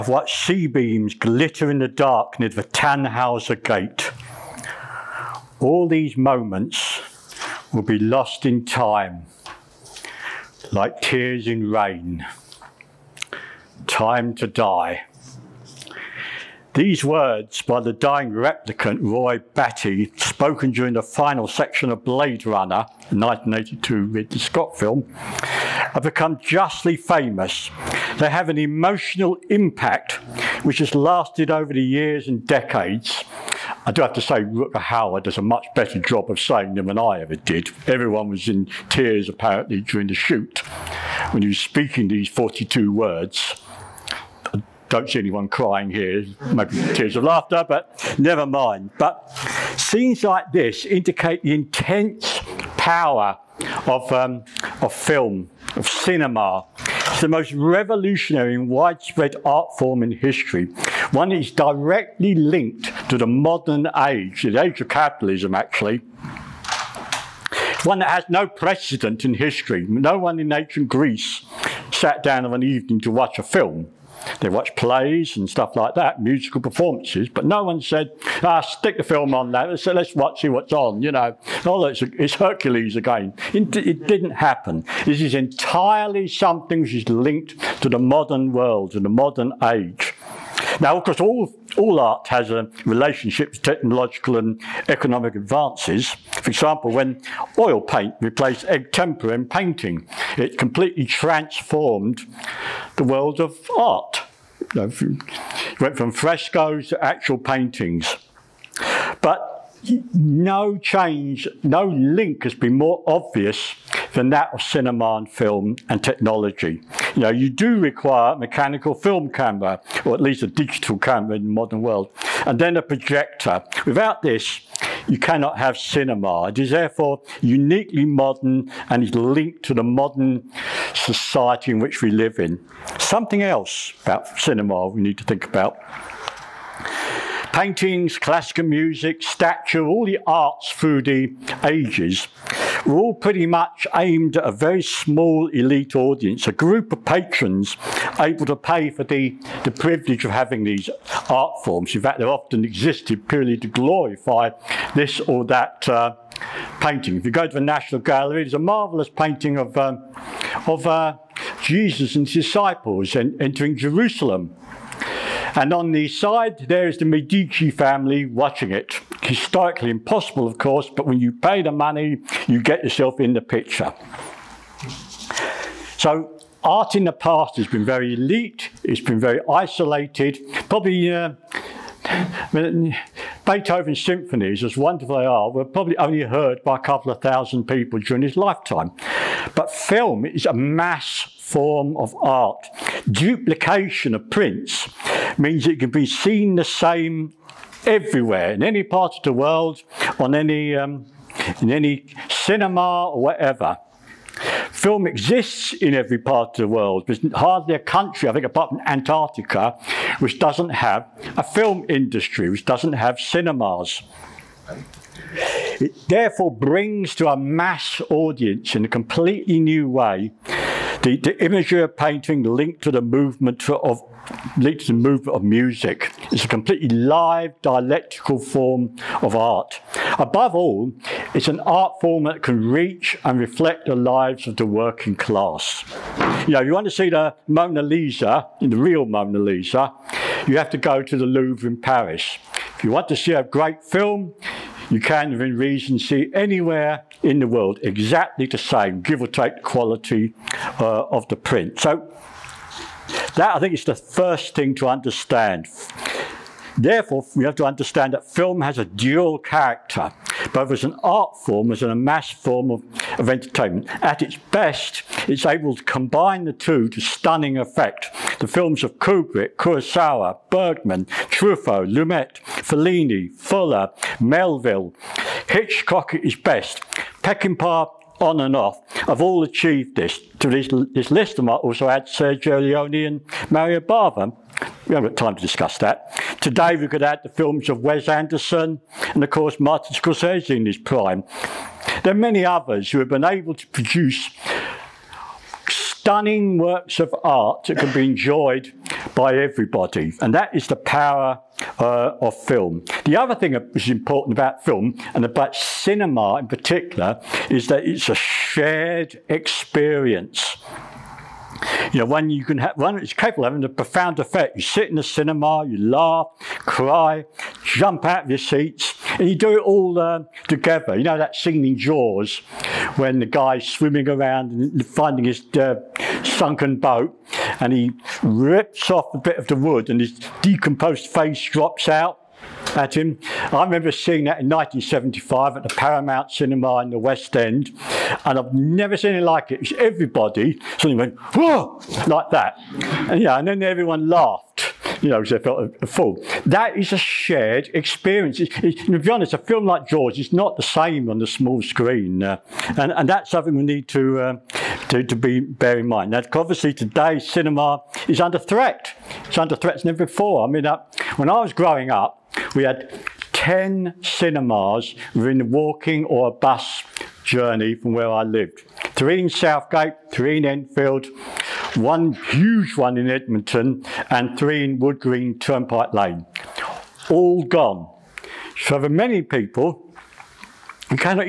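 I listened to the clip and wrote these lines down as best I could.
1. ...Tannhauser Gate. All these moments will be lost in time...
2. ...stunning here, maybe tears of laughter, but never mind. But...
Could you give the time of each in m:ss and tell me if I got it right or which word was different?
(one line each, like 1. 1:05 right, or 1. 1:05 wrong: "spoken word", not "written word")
1. 0:02 right
2. 0:45 wrong: "crying", not "stunning".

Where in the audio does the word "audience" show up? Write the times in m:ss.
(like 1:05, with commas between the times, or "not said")
2:25, 3:38.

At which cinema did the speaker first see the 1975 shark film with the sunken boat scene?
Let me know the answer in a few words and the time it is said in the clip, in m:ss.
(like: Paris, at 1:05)
Paramount Cinema, at 5:35.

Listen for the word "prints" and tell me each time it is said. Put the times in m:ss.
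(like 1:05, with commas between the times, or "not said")
3:14, 4:11.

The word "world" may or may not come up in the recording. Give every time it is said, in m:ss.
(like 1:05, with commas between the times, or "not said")
1:28, 1:43, 2:01, 3:19, 3:26, 4:07.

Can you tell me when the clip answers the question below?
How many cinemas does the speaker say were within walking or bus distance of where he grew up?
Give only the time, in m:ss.
6:03.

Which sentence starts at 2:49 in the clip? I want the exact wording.
Historically impossible, of course, but when you pay the money, you get yourself in the picture.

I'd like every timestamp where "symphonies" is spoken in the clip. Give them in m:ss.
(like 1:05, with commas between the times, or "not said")
3:04.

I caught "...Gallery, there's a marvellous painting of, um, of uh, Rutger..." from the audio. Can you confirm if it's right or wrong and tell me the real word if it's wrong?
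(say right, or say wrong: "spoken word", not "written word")
wrong: "Jesus", not "Rutger".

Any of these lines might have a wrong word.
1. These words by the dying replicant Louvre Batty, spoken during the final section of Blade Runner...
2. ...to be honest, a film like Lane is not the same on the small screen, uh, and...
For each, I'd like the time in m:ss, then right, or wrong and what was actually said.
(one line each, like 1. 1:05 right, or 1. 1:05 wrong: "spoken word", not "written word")
1. 0:16 wrong: "Roy", not "Louvre"
2. 5:48 wrong: "Jaws", not "Lane".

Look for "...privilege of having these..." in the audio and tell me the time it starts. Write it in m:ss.
2:29.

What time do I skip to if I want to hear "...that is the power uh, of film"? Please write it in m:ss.
5:00.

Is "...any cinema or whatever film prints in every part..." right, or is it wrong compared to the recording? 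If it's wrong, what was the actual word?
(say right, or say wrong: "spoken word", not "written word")
wrong: "exists", not "prints".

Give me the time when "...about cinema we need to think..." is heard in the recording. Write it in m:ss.
2:14.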